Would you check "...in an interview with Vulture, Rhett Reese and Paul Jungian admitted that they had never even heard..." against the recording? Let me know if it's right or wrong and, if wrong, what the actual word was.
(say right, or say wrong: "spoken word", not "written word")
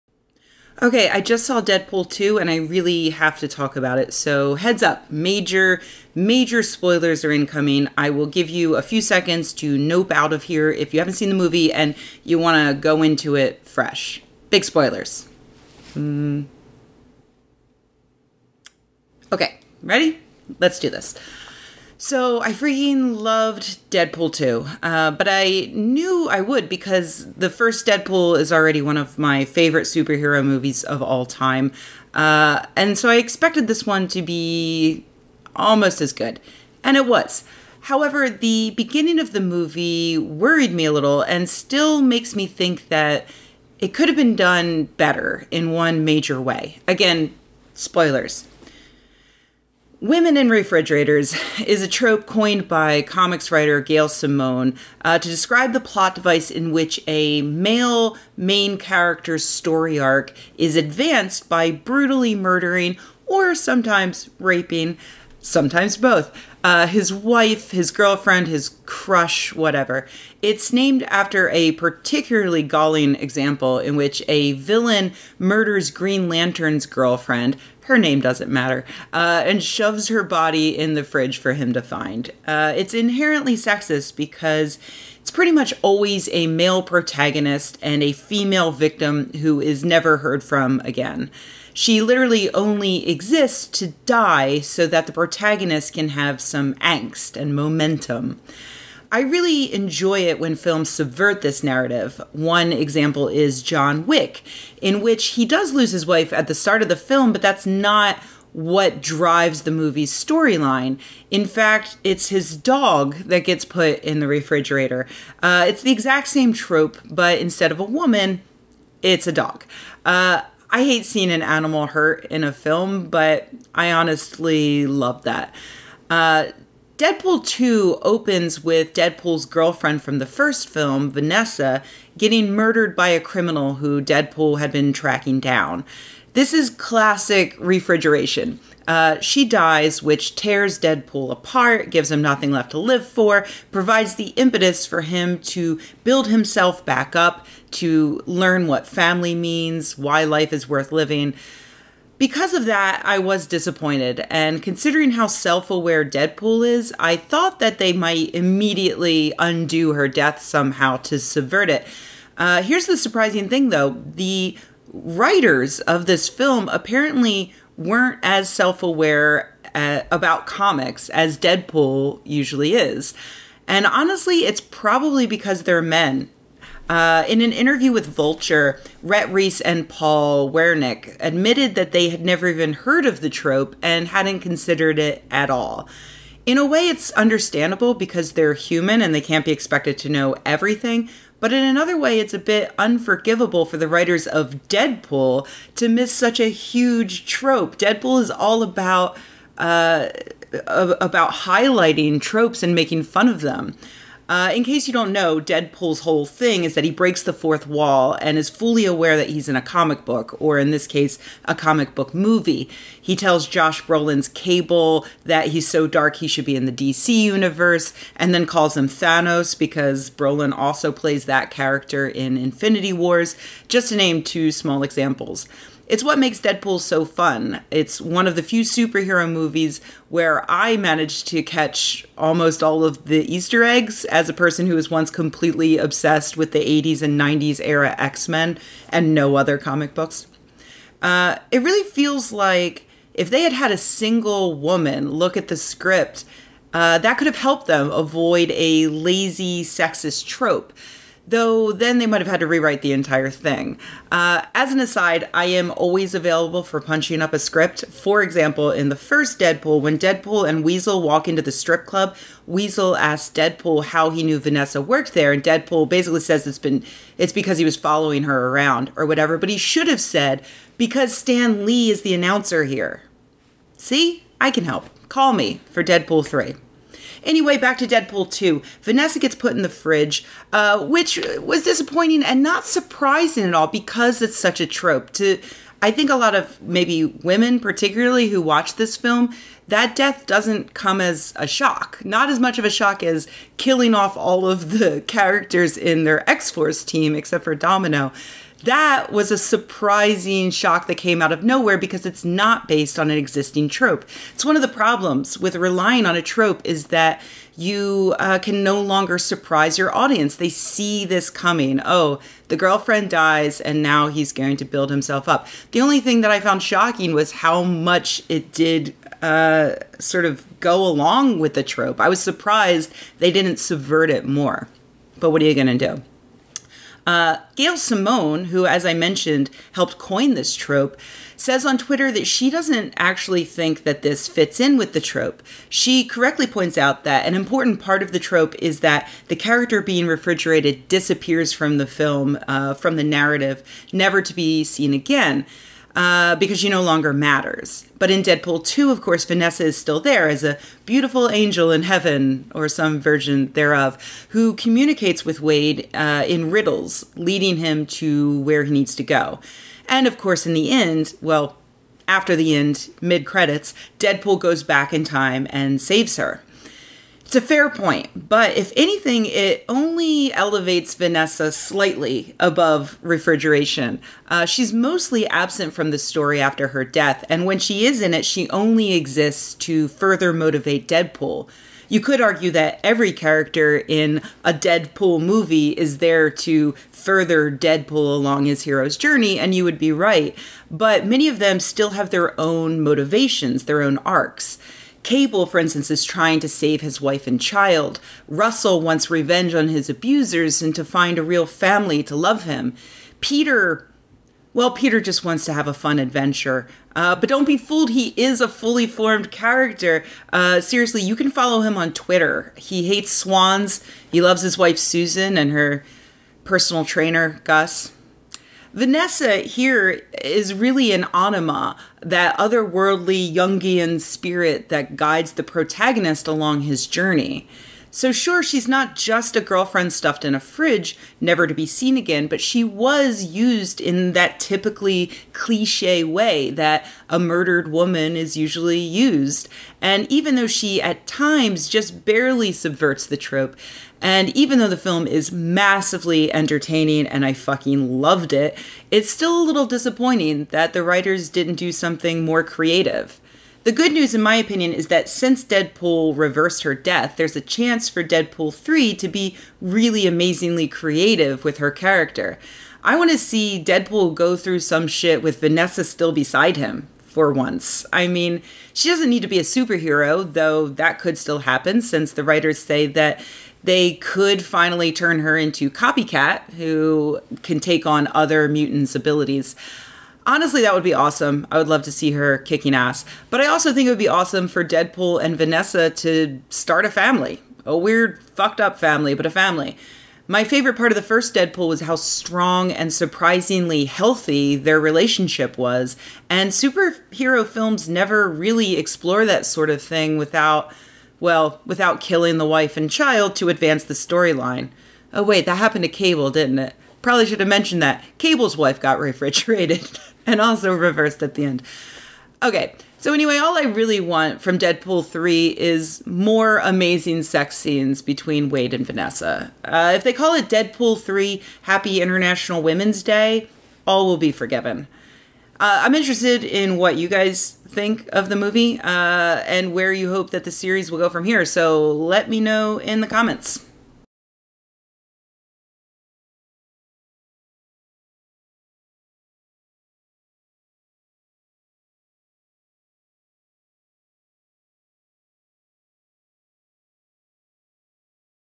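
wrong: "Wernick", not "Jungian".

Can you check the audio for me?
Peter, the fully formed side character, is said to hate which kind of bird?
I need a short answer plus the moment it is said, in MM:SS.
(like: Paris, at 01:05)
swans, at 06:53.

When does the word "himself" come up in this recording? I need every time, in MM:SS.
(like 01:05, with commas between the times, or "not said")
02:26, 05:14.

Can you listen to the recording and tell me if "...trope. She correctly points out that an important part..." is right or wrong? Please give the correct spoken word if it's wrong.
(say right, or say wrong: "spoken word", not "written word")
right.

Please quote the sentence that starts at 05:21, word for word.
I was surprised they didn't subvert it more.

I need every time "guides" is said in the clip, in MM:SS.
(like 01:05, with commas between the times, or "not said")
07:04.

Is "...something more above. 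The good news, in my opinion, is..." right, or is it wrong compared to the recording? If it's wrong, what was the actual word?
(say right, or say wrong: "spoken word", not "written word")
wrong: "creative", not "above".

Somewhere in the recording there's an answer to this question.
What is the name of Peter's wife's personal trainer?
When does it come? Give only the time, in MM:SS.
06:57.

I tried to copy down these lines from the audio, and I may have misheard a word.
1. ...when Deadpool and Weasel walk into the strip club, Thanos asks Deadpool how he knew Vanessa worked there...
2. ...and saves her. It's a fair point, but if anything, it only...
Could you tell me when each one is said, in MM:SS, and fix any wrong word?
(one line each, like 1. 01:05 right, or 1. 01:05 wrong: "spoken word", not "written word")
1. 04:19 wrong: "Weasel", not "Thanos"
2. 06:05 right.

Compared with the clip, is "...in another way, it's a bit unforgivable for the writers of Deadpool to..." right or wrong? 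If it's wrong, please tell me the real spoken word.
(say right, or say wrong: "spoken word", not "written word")
right.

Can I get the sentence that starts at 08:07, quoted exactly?
A weird, fucked up family, but a family.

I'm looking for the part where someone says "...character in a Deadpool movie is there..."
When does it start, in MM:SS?
06:23.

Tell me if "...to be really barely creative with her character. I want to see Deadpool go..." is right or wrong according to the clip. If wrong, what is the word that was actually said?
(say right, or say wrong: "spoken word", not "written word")
wrong: "amazingly", not "barely".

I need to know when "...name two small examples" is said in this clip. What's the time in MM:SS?
03:43.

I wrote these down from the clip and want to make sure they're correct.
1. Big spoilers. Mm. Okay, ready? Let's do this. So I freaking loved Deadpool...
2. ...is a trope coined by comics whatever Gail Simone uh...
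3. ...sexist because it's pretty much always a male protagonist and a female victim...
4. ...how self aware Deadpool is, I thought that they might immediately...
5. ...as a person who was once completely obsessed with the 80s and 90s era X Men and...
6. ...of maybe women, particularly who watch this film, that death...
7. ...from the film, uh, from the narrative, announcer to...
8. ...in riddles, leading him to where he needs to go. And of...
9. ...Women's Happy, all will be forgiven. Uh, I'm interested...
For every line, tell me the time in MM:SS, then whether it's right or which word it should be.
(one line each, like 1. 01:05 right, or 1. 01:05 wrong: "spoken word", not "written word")
1. 00:14 right
2. 00:51 wrong: "writer", not "whatever"
3. 01:23 right
4. 02:35 right
5. 03:54 right
6. 04:46 right
7. 05:41 wrong: "never", not "announcer"
8. 05:56 right
9. 08:42 wrong: "Day", not "Happy".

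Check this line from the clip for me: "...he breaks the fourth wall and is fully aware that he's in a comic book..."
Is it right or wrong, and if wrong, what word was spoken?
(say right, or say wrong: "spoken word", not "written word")
right.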